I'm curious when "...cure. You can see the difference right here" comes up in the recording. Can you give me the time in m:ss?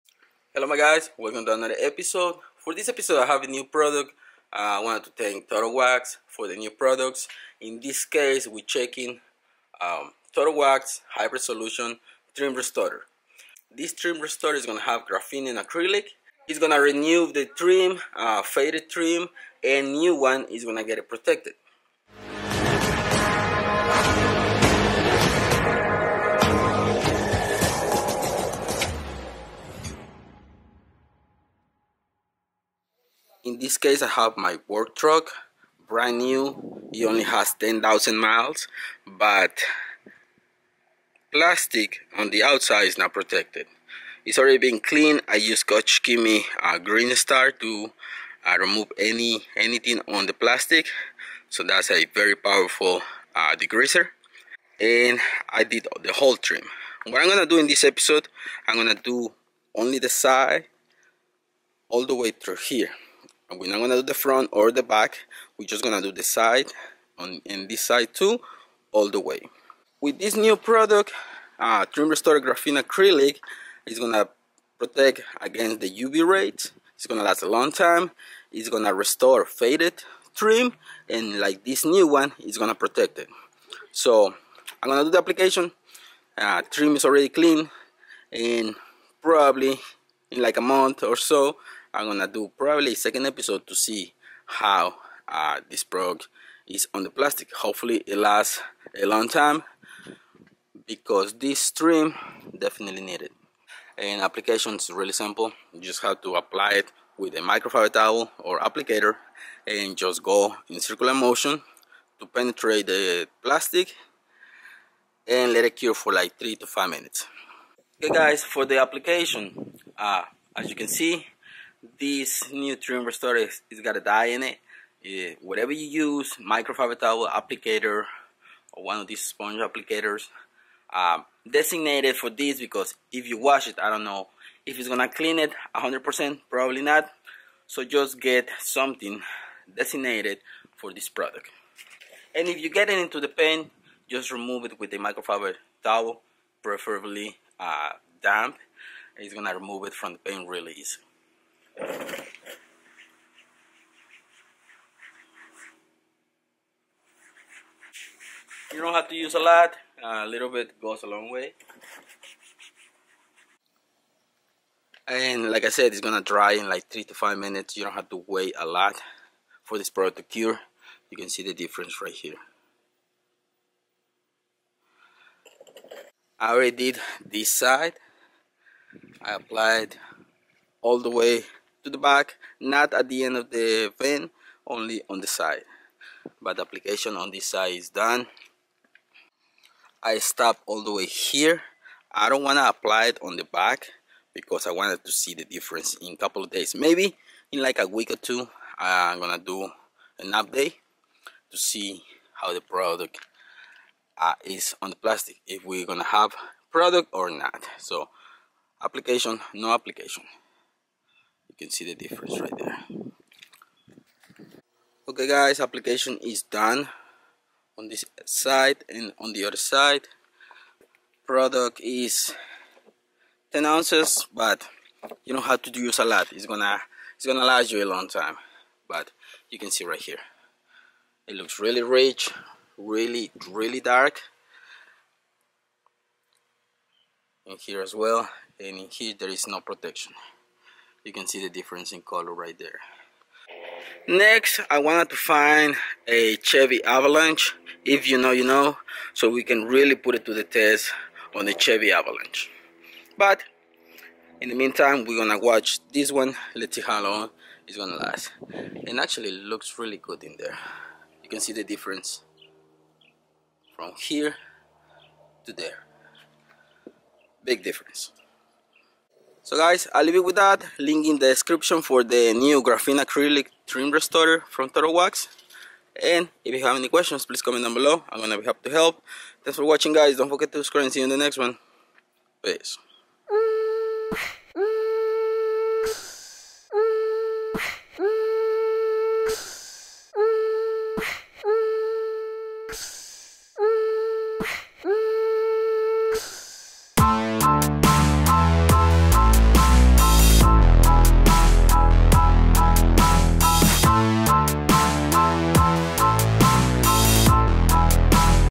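2:50.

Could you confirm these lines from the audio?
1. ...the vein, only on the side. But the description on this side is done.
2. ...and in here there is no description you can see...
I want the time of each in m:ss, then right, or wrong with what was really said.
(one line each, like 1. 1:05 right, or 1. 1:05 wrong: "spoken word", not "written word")
1. 3:03 wrong: "application", not "description"
2. 3:58 wrong: "protection", not "description".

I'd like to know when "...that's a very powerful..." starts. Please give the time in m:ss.
0:51.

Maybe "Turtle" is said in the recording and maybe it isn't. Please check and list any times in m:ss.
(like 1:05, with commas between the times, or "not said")
0:05, 0:10, 4:34.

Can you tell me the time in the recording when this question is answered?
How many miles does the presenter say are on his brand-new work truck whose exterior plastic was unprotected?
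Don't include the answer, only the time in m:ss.
0:37.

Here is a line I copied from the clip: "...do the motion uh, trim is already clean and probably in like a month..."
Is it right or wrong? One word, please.
wrong.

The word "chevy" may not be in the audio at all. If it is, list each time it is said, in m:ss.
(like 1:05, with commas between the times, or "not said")
4:06, 4:11.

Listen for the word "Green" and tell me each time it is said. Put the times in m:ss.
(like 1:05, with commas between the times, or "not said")
0:46.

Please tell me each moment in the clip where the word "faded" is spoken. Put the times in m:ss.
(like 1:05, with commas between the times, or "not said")
0:18, 1:19.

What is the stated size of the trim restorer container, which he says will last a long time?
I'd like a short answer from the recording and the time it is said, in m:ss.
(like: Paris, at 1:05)
10 ounces, at 3:43.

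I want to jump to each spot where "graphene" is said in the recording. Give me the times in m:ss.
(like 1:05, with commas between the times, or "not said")
0:15, 1:12, 4:32.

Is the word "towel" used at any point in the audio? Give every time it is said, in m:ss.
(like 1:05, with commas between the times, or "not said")
1:47, 2:06, 2:25.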